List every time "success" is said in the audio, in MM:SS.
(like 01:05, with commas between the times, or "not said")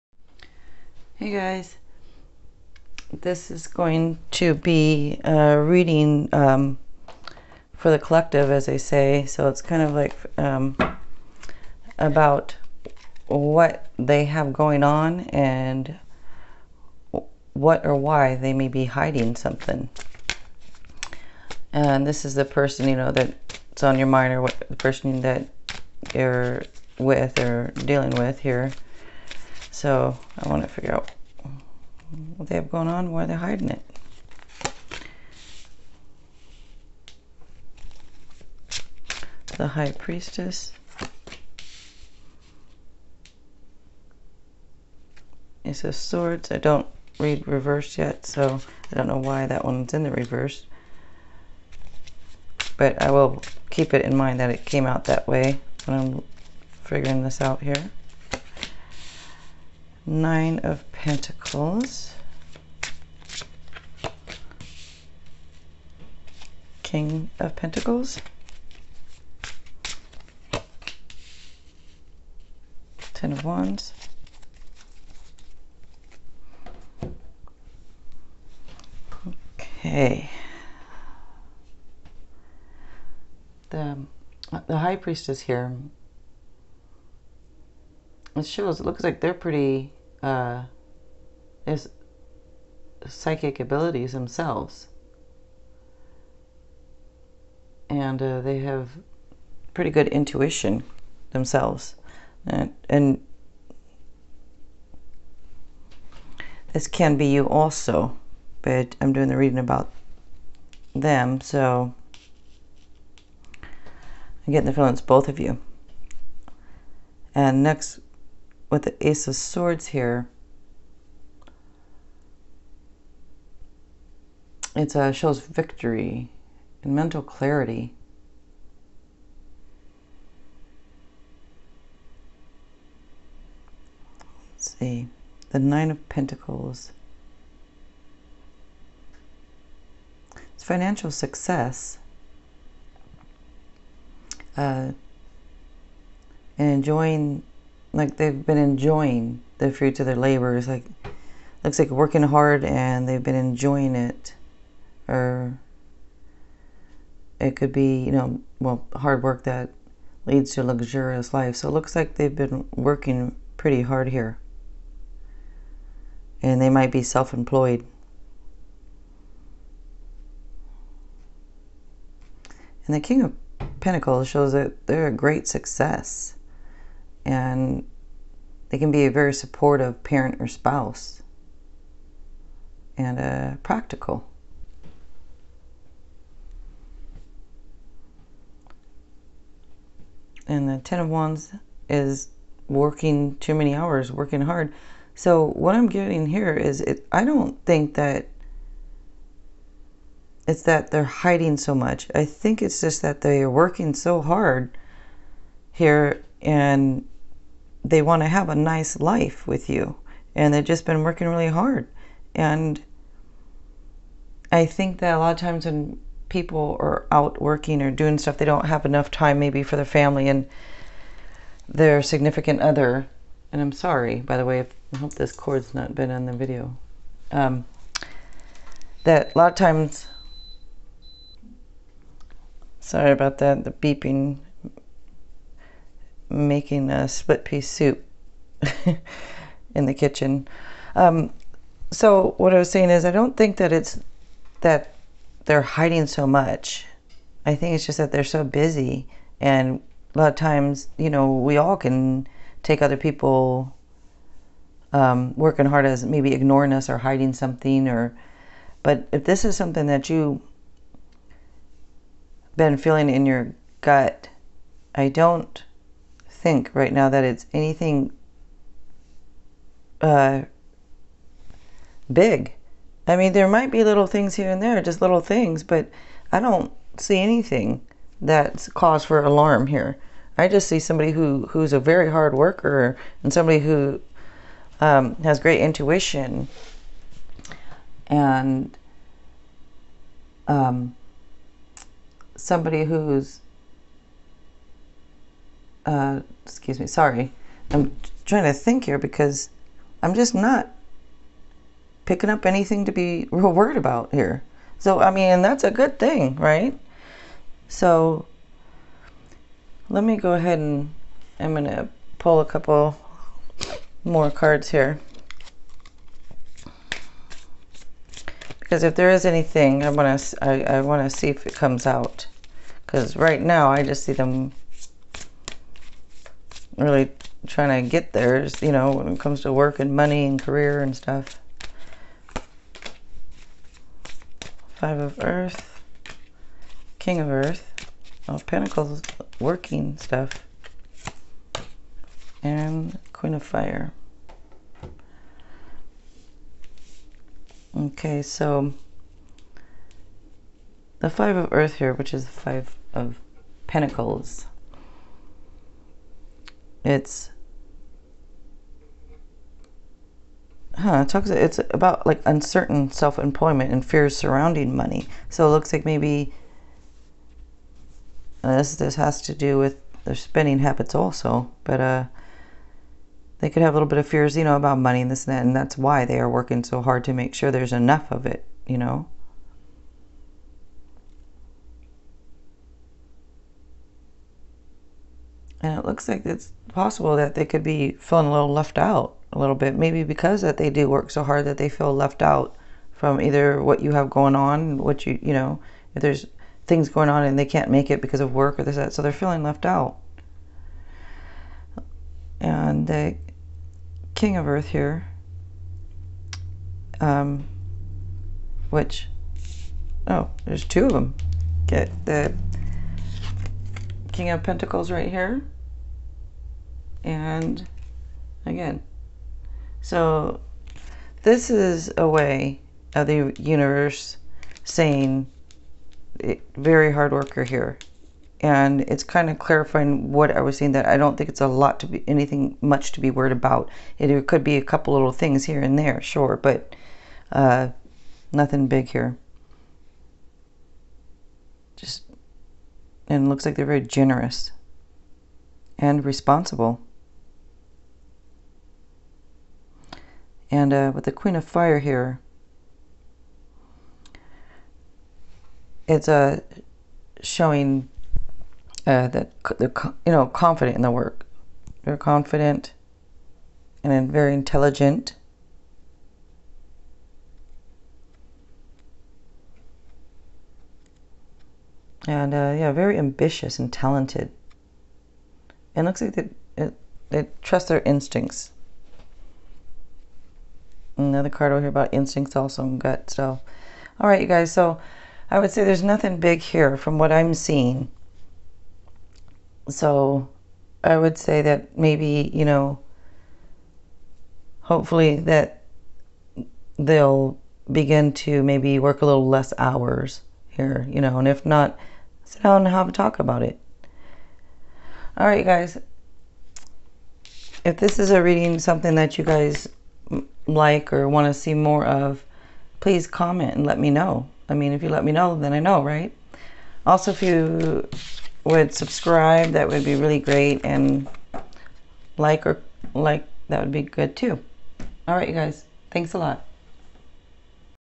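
02:21, 02:55.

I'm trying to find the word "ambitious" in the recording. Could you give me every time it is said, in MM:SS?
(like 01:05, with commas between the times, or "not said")
07:52.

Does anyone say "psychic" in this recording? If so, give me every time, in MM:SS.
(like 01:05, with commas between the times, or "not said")
01:33.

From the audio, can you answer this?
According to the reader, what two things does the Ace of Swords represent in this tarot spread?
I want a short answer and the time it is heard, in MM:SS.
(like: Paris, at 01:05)
victory and mental clarity, at 02:05.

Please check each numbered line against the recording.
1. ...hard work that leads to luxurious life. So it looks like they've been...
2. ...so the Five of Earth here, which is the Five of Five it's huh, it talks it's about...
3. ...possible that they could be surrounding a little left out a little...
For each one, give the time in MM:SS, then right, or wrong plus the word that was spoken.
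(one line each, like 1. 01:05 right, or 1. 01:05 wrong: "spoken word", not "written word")
1. 02:38 right
2. 05:48 wrong: "Pentacles", not "Five"
3. 06:26 wrong: "feeling", not "surrounding".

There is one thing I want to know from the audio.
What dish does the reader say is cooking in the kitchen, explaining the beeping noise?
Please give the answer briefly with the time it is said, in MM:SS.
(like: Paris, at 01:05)
split pea soup, at 03:57.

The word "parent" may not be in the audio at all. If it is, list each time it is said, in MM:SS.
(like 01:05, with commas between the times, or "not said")
03:00.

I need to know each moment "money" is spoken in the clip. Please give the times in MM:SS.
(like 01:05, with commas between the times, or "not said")
05:29, 06:04, 06:14.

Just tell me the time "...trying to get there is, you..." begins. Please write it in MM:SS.
05:27.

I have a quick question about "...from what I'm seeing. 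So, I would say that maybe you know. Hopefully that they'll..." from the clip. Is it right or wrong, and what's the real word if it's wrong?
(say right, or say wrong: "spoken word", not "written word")
right.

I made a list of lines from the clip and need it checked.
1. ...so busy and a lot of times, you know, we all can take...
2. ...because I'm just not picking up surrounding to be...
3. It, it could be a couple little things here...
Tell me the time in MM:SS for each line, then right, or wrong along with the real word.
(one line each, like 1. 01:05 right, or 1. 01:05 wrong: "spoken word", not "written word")
1. 04:08 right
2. 04:58 wrong: "anything", not "surrounding"
3. 07:13 right.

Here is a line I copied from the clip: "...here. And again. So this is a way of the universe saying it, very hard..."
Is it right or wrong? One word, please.
right.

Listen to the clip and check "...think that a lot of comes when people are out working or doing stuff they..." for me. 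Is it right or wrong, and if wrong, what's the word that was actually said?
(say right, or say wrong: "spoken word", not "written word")
wrong: "times", not "comes".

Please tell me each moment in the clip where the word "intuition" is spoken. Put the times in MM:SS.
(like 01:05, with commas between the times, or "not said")
01:40, 04:45.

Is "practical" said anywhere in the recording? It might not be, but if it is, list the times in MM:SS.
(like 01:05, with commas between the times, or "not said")
03:03.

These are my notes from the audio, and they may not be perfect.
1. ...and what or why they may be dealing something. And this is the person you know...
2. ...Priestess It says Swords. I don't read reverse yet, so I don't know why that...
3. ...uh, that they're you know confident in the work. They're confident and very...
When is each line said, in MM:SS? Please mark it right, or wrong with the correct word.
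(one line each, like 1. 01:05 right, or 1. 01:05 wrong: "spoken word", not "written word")
1. 00:15 wrong: "hiding", not "dealing"
2. 00:39 right
3. 07:38 right.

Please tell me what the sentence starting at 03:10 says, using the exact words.
And the Ten of Wands is working too many hours, working hard.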